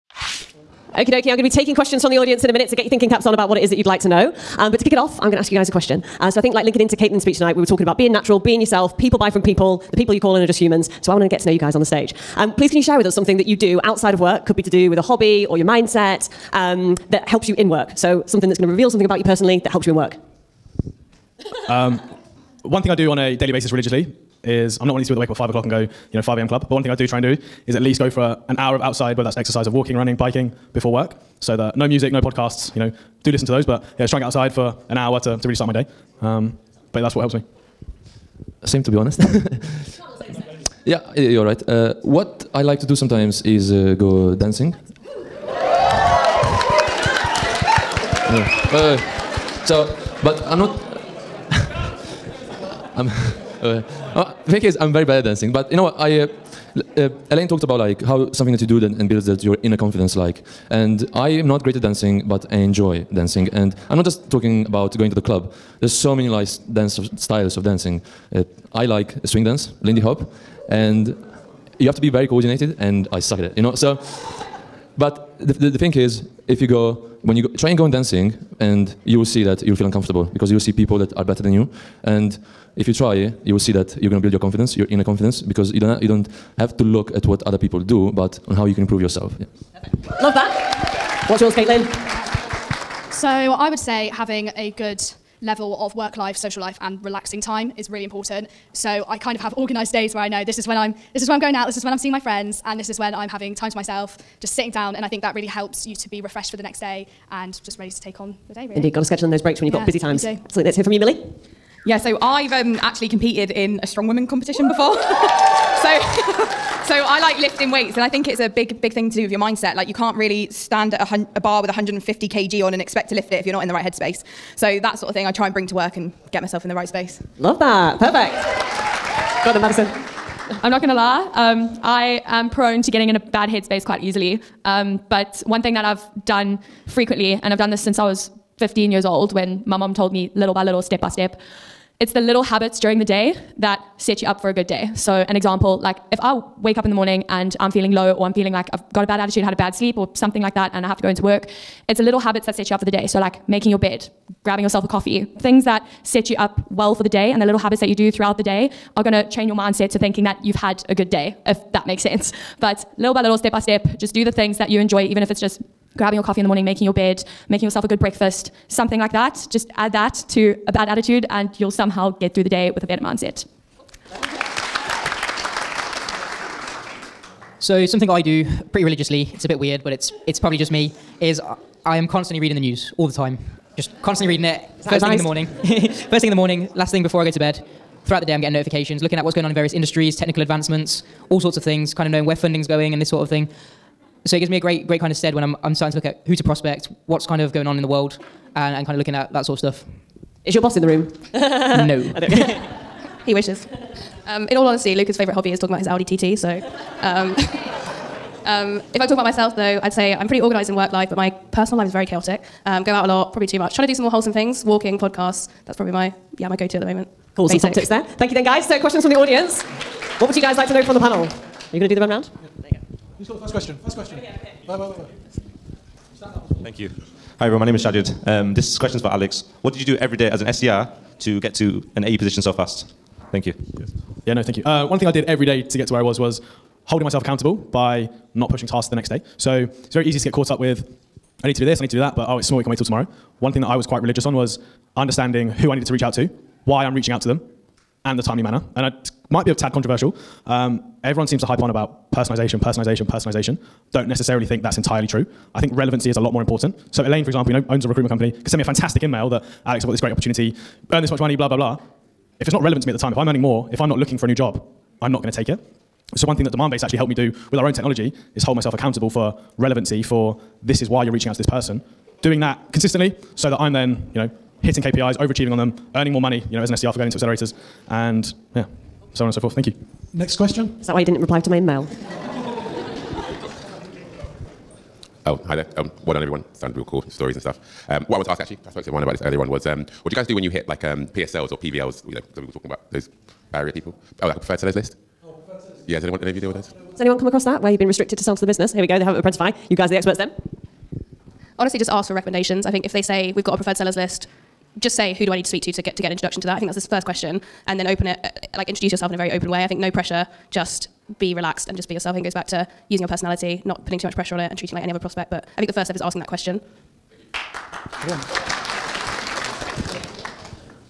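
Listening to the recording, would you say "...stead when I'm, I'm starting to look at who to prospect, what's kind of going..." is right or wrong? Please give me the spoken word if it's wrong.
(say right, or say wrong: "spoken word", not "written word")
right.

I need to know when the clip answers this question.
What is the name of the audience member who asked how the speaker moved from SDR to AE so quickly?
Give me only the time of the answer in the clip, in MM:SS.
03:47.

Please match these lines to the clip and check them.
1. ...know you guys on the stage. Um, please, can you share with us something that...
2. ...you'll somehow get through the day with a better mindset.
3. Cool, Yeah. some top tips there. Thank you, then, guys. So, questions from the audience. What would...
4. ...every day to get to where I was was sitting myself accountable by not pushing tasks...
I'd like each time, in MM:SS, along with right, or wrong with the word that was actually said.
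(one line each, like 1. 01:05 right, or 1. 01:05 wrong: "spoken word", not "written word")
1. 00:11 right
2. 02:51 right
3. 03:37 wrong: "Basic", not "Yeah"
4. 03:55 wrong: "holding", not "sitting".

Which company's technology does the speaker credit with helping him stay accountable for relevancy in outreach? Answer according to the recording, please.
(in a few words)
Demandbase.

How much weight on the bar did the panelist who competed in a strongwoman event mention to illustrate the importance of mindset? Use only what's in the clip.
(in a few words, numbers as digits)
150 kg.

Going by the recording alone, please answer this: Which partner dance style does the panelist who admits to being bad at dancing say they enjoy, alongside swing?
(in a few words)
Lindy Hop.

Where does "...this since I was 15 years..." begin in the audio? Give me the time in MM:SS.
02:17.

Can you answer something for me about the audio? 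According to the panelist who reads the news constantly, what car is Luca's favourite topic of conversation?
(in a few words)
Audi TT.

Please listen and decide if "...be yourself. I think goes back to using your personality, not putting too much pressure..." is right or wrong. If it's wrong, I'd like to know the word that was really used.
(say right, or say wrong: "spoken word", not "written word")
right.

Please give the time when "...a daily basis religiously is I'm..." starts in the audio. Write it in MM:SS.
00:23.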